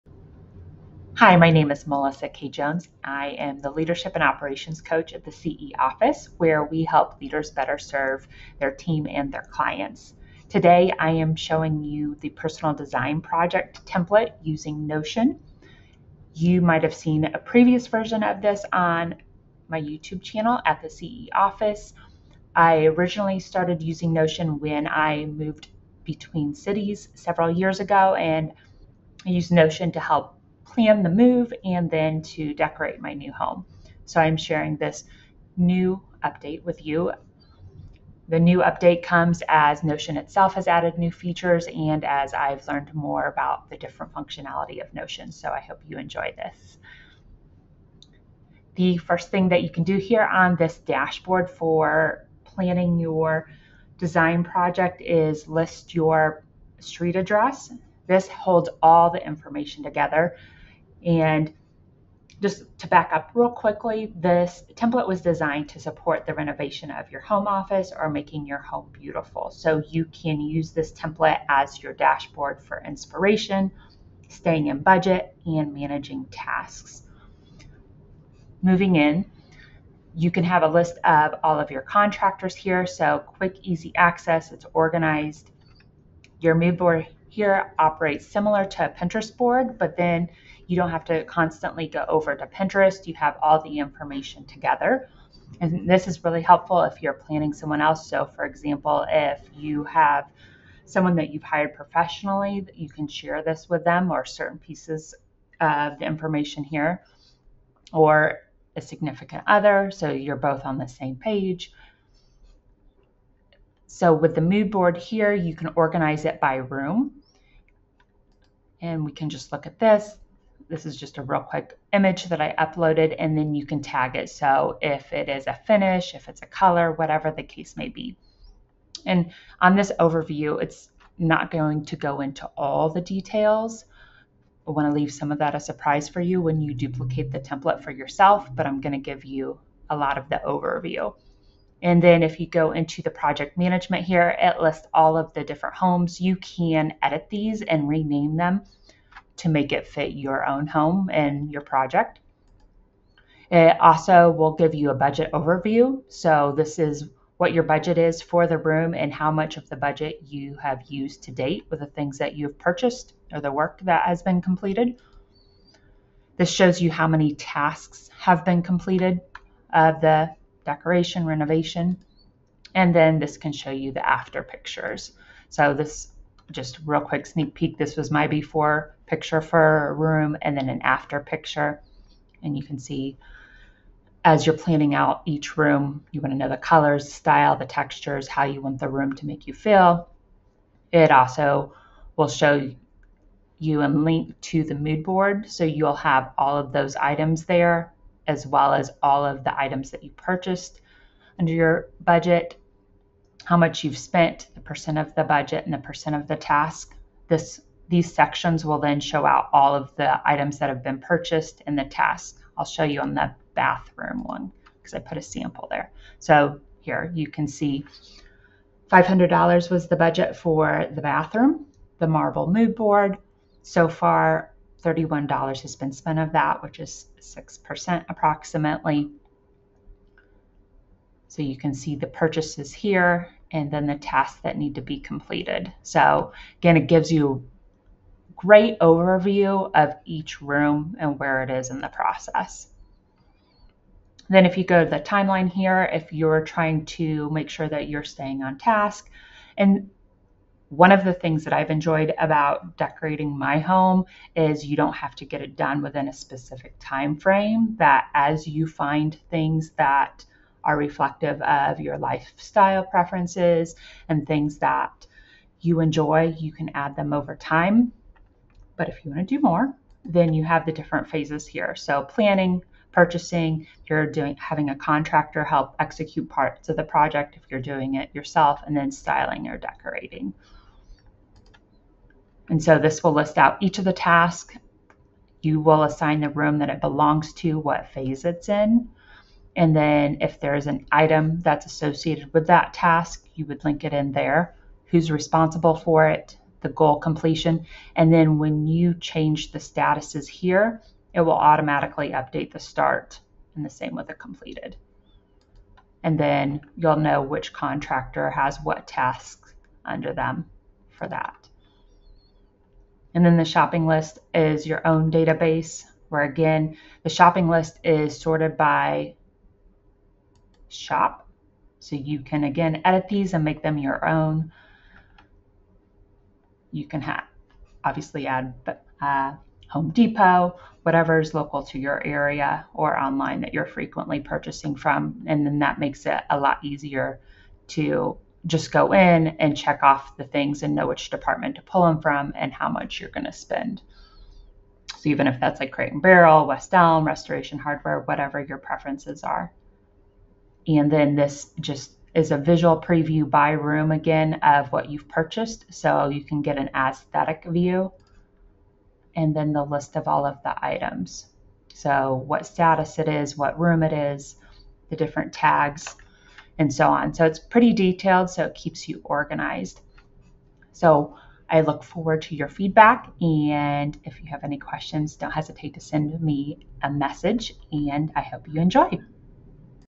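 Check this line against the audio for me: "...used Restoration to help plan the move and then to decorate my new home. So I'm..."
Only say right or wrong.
wrong.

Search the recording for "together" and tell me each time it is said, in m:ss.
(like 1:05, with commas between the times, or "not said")
0:59, 1:34.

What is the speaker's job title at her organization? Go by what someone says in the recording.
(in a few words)
Leadership and Operations Coach.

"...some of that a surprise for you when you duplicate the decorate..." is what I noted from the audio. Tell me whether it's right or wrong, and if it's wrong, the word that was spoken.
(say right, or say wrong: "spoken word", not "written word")
wrong: "template", not "decorate".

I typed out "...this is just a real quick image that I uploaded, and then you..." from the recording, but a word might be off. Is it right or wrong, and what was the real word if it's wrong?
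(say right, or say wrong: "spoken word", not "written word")
right.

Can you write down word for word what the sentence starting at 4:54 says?
Who's responsible for it, the goal completion.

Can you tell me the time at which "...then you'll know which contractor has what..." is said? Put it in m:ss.
5:06.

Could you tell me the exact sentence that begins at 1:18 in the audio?
Moving in, you can have a list of all of your contractors here.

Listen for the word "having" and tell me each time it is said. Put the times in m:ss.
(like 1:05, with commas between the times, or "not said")
4:34.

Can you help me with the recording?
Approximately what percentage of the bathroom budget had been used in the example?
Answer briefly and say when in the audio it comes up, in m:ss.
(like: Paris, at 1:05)
6%, at 3:47.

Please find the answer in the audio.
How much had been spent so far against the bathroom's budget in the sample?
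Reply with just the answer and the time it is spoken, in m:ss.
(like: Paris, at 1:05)
$31, at 3:44.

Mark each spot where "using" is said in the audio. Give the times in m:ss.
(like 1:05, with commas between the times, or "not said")
0:14, 0:23.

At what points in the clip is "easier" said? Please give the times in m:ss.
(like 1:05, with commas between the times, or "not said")
5:36.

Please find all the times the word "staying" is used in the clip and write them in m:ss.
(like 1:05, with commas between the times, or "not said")
1:14, 4:08.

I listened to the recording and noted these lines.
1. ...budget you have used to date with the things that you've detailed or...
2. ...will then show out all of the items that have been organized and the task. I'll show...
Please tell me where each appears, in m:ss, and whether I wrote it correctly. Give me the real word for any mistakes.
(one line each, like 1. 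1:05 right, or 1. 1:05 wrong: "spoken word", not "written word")
1. 2:39 wrong: "purchased", not "detailed"
2. 3:28 wrong: "purchased", not "organized".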